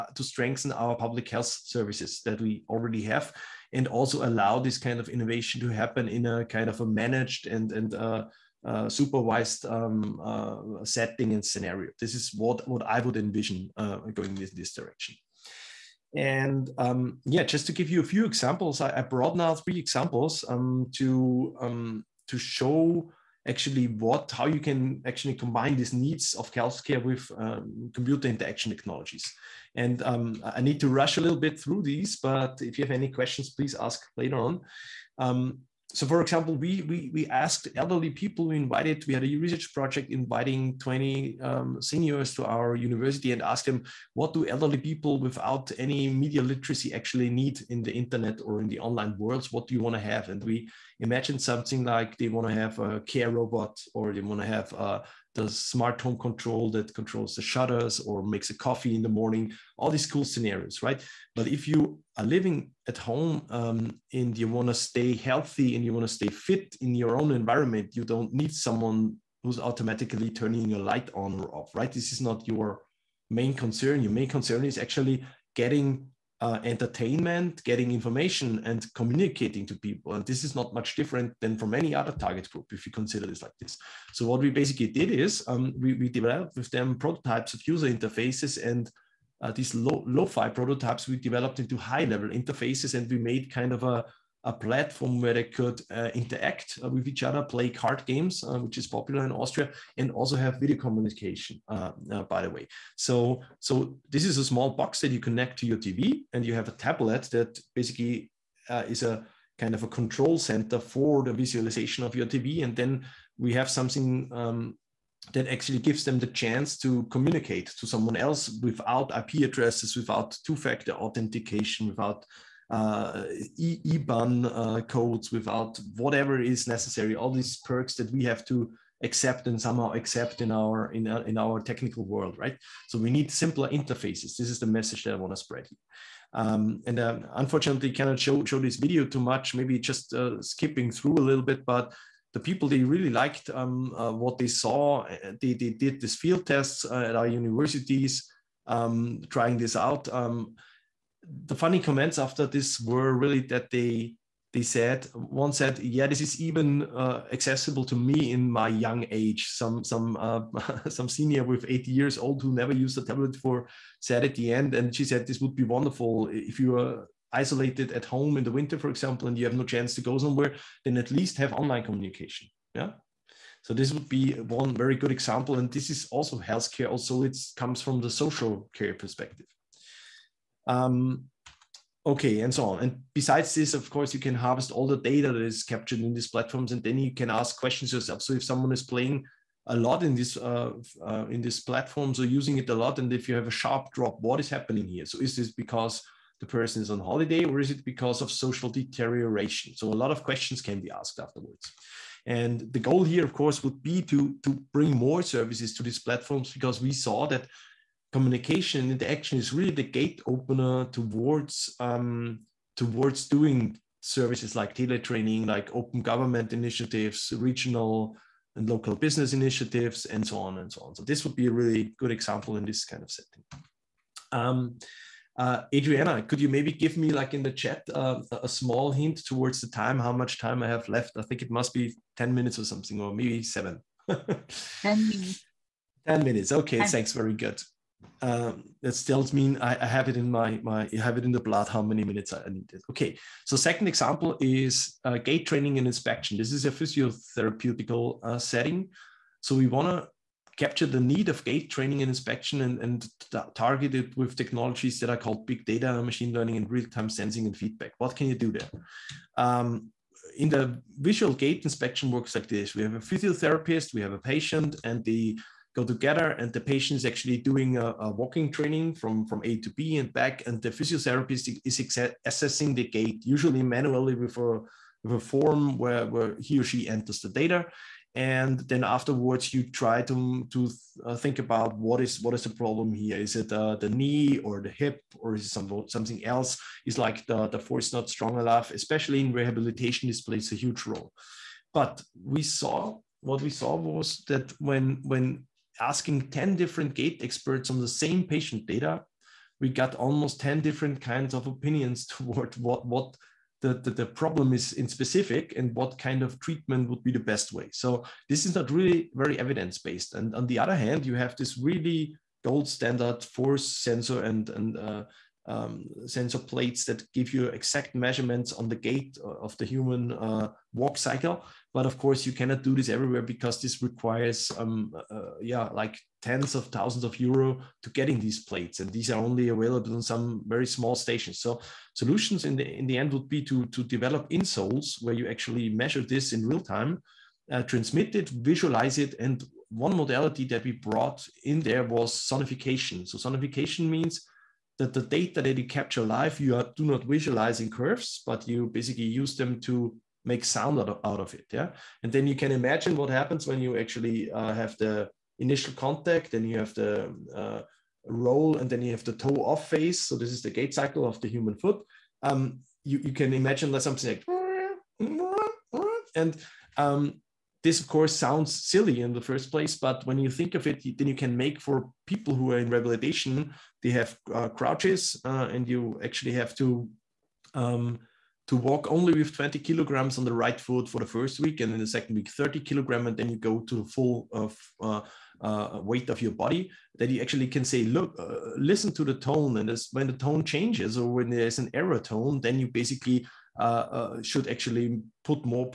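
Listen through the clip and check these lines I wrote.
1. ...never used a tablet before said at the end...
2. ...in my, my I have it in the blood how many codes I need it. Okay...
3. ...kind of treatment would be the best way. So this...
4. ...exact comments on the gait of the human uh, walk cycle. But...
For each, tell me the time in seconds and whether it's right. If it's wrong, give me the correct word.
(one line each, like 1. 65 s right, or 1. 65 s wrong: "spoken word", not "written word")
1. 162 s right
2. 240 s wrong: "minutes", not "codes"
3. 305 s right
4. 317 s wrong: "measurements", not "comments".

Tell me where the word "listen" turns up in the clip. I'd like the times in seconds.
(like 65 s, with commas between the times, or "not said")
388 s.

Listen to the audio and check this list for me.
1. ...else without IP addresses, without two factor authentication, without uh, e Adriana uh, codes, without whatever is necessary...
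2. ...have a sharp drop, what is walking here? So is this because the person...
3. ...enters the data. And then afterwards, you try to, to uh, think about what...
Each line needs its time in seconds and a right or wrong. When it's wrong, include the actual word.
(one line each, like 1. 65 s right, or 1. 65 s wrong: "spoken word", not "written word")
1. 118 s wrong: "IBAN", not "Adriana"
2. 193 s wrong: "happening", not "walking"
3. 276 s right.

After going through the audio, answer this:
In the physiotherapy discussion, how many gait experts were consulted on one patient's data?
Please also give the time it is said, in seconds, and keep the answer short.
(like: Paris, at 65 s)
10, at 296 s.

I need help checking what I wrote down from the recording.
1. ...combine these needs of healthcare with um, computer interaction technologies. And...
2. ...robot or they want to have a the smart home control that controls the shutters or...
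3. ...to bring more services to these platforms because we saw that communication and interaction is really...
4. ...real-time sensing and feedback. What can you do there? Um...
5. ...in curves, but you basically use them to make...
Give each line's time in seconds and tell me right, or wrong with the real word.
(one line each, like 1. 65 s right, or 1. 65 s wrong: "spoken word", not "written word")
1. 25 s right
2. 53 s right
3. 204 s right
4. 256 s right
5. 347 s right.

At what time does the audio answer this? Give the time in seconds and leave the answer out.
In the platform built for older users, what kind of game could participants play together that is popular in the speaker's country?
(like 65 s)
97 s.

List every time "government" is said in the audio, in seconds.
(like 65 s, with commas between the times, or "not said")
216 s.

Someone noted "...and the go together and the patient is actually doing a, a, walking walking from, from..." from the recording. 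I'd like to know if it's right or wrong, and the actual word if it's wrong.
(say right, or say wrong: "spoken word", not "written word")
wrong: "training", not "walking".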